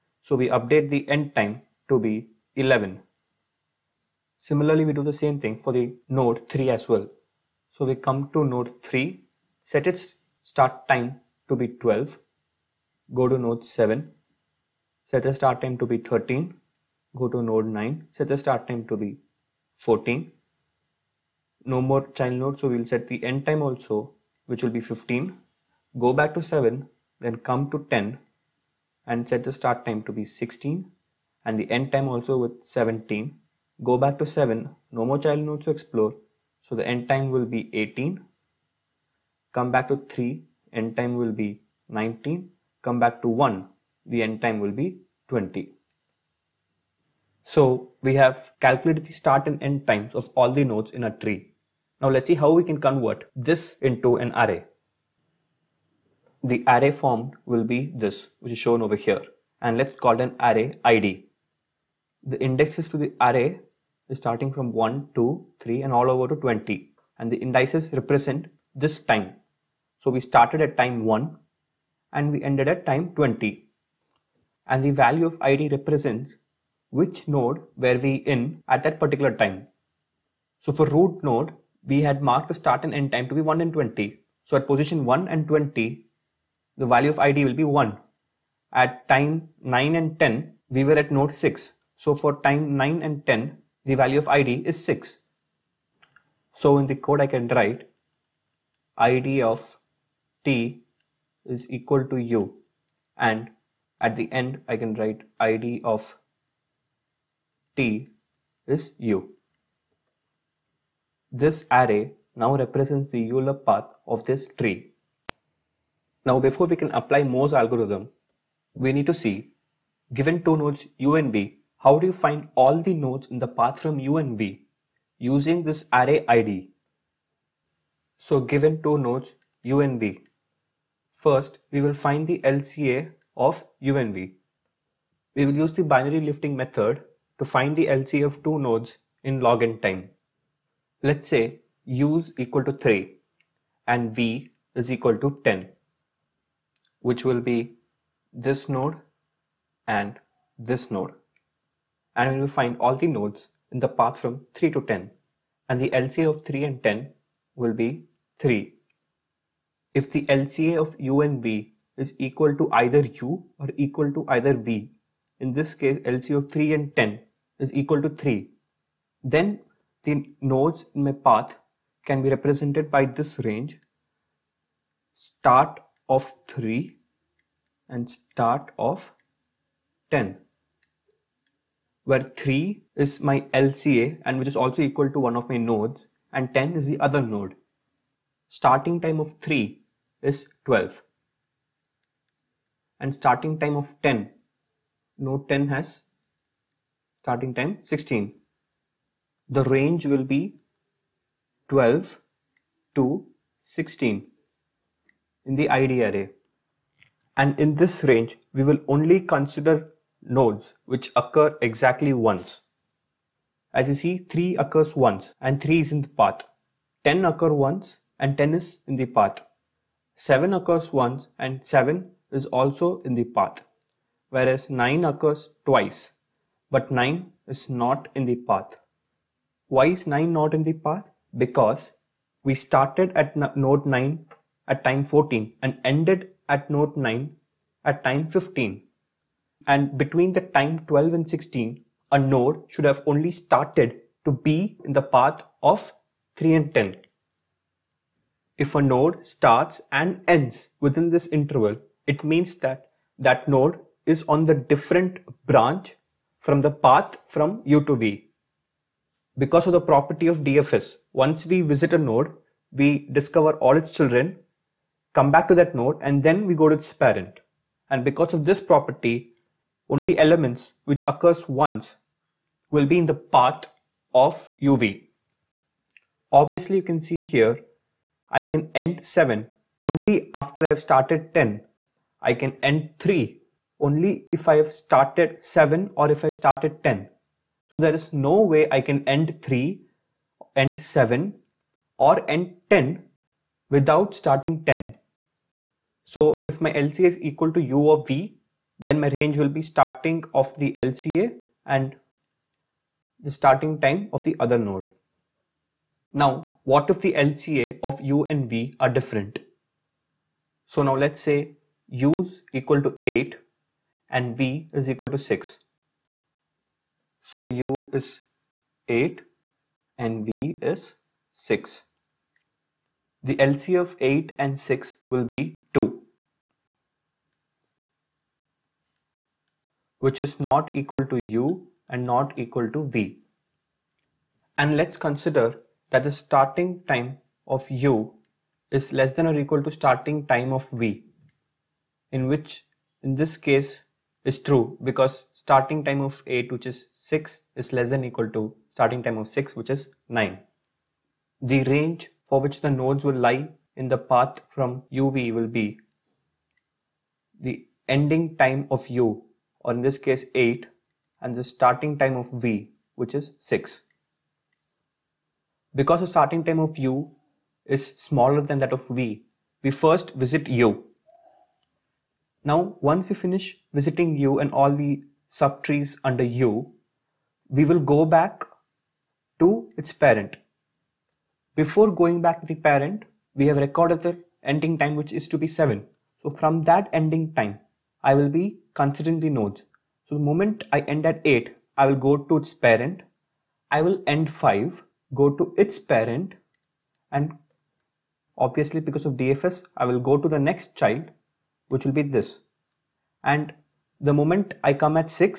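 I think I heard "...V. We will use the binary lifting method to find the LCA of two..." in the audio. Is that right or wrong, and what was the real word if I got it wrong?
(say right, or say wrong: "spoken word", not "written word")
right.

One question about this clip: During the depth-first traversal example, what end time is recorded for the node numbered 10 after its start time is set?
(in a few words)
17.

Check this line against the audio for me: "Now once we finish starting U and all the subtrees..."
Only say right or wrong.
wrong.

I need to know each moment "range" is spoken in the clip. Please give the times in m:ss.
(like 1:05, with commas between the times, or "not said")
2:53, 3:19, 3:28, 4:59, 5:51.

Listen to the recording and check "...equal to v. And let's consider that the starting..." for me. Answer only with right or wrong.
right.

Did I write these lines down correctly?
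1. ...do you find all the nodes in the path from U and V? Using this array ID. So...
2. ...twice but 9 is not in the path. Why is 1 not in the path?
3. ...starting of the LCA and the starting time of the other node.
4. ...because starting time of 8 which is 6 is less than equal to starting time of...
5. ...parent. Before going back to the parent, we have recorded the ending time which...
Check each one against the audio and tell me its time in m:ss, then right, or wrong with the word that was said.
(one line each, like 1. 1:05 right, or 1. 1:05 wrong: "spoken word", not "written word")
1. 2:01 right
2. 3:45 wrong: "9", not "1"
3. 4:59 right
4. 5:44 right
5. 6:19 right.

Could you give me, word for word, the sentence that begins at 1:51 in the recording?
This array now represents the Euler path of this tree.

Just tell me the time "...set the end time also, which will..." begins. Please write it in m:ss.
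0:22.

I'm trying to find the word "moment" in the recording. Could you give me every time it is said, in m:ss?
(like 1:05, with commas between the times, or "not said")
6:30, 6:44.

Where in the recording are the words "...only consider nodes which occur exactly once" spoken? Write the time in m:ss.
3:28.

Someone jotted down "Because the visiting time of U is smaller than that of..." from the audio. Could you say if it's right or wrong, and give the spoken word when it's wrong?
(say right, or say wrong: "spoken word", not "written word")
wrong: "starting", not "visiting".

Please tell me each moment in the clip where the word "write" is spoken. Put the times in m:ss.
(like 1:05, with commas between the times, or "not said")
1:37, 1:44.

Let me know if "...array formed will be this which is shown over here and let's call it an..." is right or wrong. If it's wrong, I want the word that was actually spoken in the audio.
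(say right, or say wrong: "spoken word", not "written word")
right.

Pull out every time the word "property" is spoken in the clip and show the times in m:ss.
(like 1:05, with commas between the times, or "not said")
4:19, 4:28.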